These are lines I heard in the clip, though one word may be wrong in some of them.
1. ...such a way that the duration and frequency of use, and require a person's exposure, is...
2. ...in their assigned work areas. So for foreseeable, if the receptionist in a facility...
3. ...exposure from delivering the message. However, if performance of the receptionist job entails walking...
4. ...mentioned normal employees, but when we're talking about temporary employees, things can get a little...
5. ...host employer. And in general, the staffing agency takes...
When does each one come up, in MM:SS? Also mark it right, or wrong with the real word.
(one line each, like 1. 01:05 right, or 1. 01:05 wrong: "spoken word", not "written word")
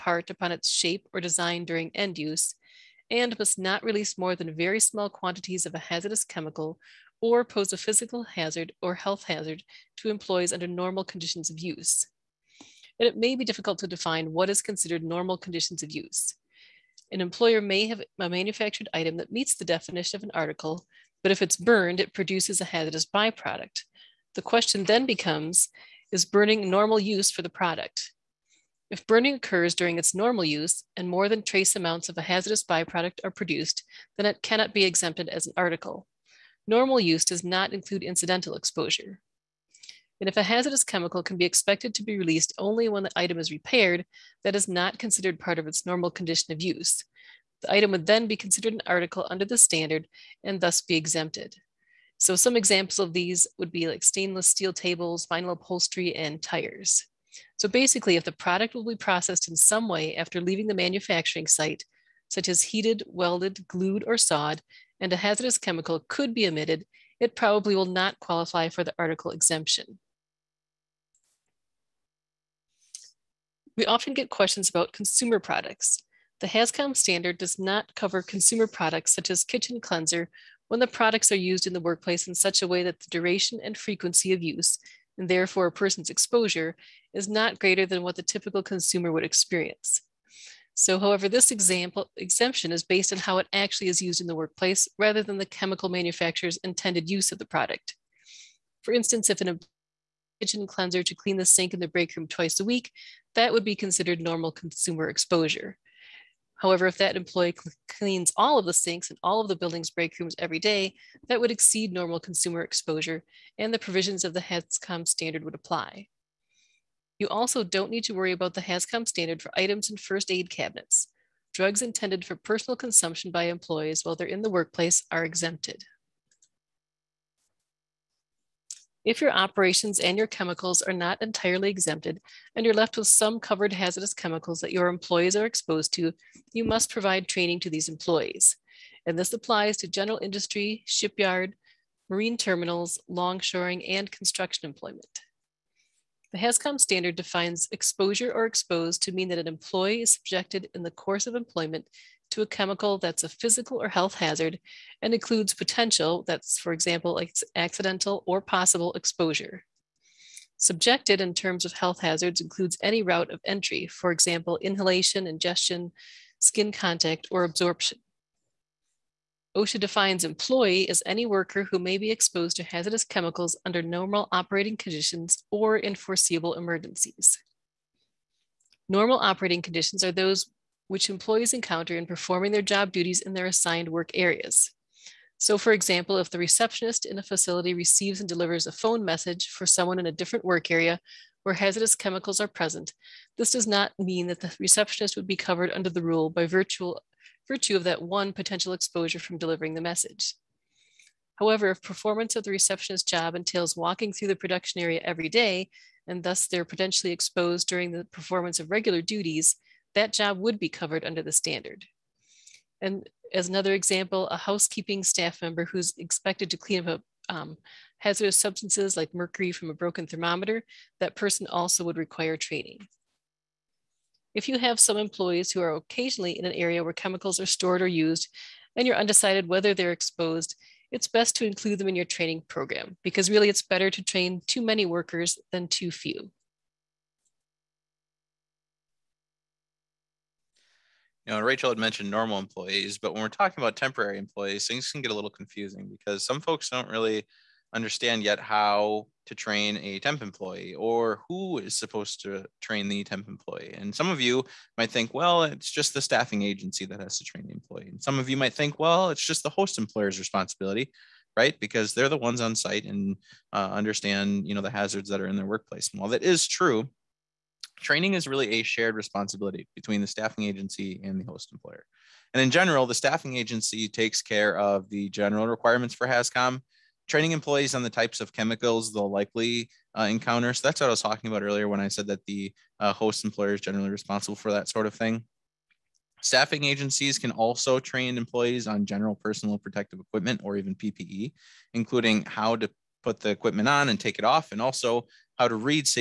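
1. 01:22 wrong: "therefore", not "require"
2. 03:03 wrong: "example", not "foreseeable"
3. 03:18 right
4. 04:01 right
5. 04:31 right.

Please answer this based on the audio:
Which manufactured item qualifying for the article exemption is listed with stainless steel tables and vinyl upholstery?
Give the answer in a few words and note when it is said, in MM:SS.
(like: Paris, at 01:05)
Tires, at 00:56.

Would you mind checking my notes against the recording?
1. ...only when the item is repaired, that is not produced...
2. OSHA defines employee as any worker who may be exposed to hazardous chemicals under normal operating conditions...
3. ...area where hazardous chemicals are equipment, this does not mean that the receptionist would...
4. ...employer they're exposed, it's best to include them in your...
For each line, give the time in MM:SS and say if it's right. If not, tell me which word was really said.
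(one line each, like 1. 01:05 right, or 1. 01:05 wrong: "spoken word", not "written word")
1. 00:42 wrong: "considered", not "produced"
2. 02:49 right
3. 03:10 wrong: "present", not "equipment"
4. 03:49 wrong: "whether", not "employer".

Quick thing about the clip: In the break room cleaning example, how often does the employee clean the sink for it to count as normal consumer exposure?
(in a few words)
Twice a week.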